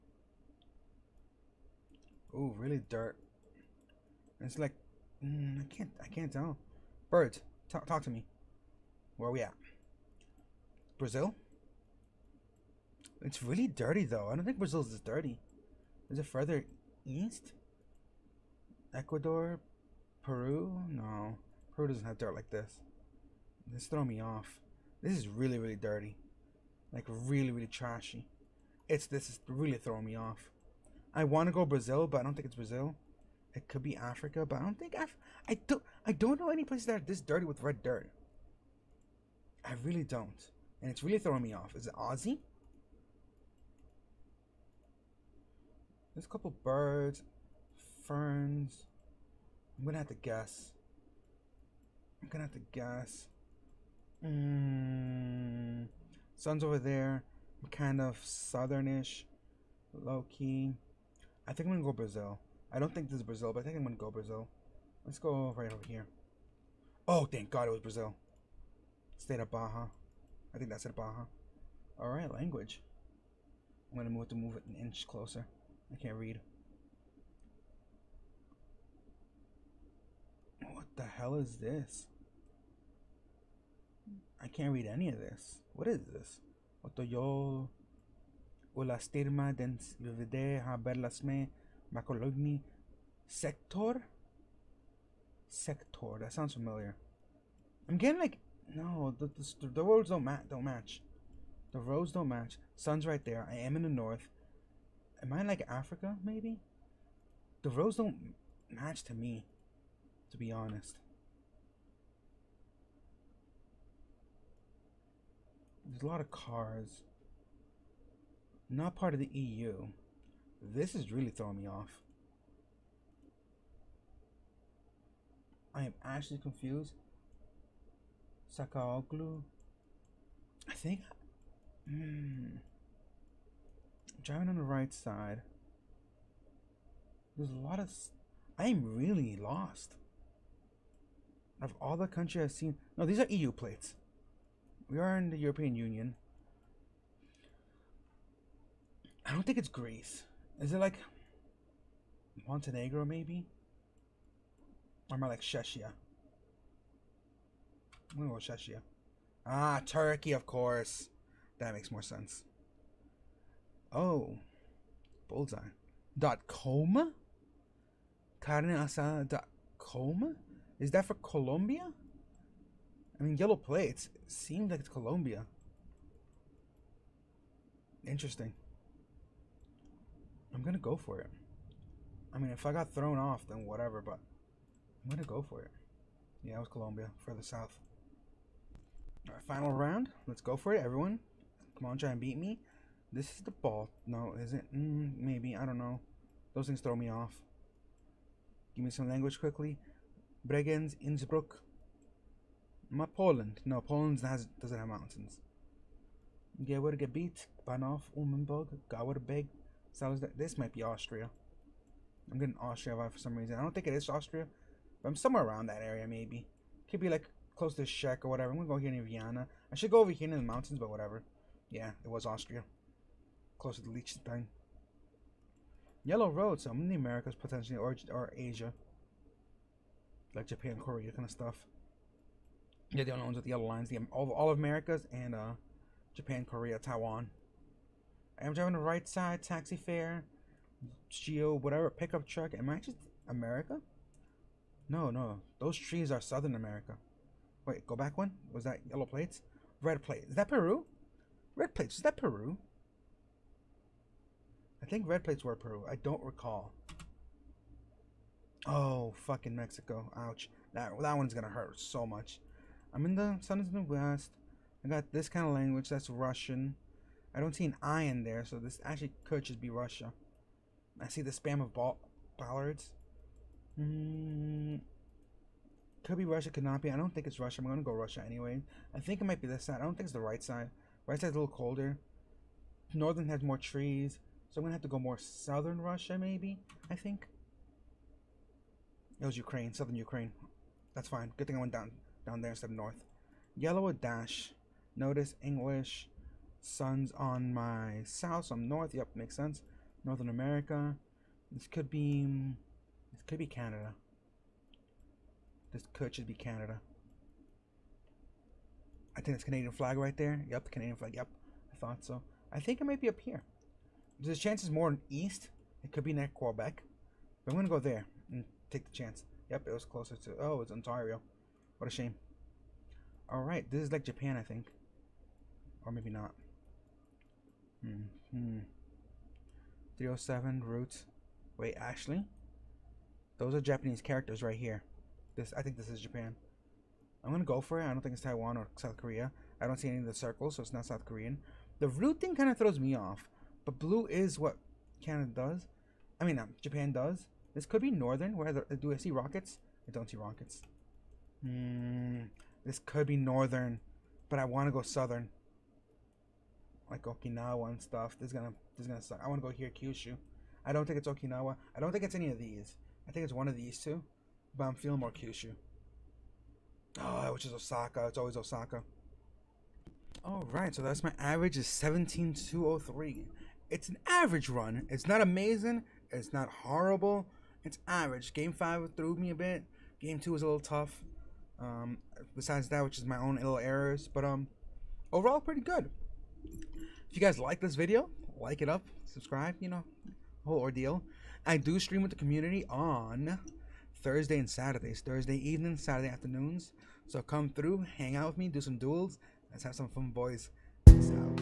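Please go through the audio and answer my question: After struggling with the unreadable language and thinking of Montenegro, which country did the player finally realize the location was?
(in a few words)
Turkey.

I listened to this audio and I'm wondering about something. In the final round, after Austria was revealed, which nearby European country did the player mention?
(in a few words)
Liechtenstein.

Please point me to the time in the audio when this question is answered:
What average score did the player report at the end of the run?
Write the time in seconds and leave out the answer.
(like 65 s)
371 s.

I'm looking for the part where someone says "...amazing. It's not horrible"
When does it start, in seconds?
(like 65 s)
375 s.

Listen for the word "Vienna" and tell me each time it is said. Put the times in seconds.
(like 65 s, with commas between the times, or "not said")
219 s.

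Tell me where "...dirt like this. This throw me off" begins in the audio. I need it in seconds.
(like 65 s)
22 s.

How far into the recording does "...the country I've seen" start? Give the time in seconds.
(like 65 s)
141 s.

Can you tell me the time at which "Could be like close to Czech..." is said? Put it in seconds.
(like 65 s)
216 s.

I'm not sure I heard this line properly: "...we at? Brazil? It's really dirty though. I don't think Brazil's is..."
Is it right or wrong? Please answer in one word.
right.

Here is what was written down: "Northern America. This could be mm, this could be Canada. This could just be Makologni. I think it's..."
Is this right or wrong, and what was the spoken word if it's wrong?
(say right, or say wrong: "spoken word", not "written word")
wrong: "Canada", not "Makologni".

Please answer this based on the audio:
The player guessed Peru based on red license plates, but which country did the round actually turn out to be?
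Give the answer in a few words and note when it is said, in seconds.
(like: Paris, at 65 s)
Mexico, at 259 s.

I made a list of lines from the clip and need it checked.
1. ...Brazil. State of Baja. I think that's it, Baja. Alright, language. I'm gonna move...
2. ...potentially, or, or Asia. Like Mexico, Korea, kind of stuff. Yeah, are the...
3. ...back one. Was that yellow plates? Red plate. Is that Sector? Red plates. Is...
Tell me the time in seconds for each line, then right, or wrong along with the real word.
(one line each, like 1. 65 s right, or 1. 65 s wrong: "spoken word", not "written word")
1. 67 s right
2. 227 s wrong: "Japan", not "Mexico"
3. 247 s wrong: "Peru", not "Sector".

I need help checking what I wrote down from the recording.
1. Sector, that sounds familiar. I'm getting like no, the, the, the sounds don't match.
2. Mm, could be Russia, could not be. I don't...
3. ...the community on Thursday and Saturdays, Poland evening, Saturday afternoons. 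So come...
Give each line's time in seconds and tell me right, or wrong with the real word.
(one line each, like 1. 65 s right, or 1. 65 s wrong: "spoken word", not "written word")
1. 95 s wrong: "roads", not "sounds"
2. 273 s right
3. 392 s wrong: "Thursday", not "Poland".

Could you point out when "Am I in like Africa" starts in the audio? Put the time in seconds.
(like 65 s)
105 s.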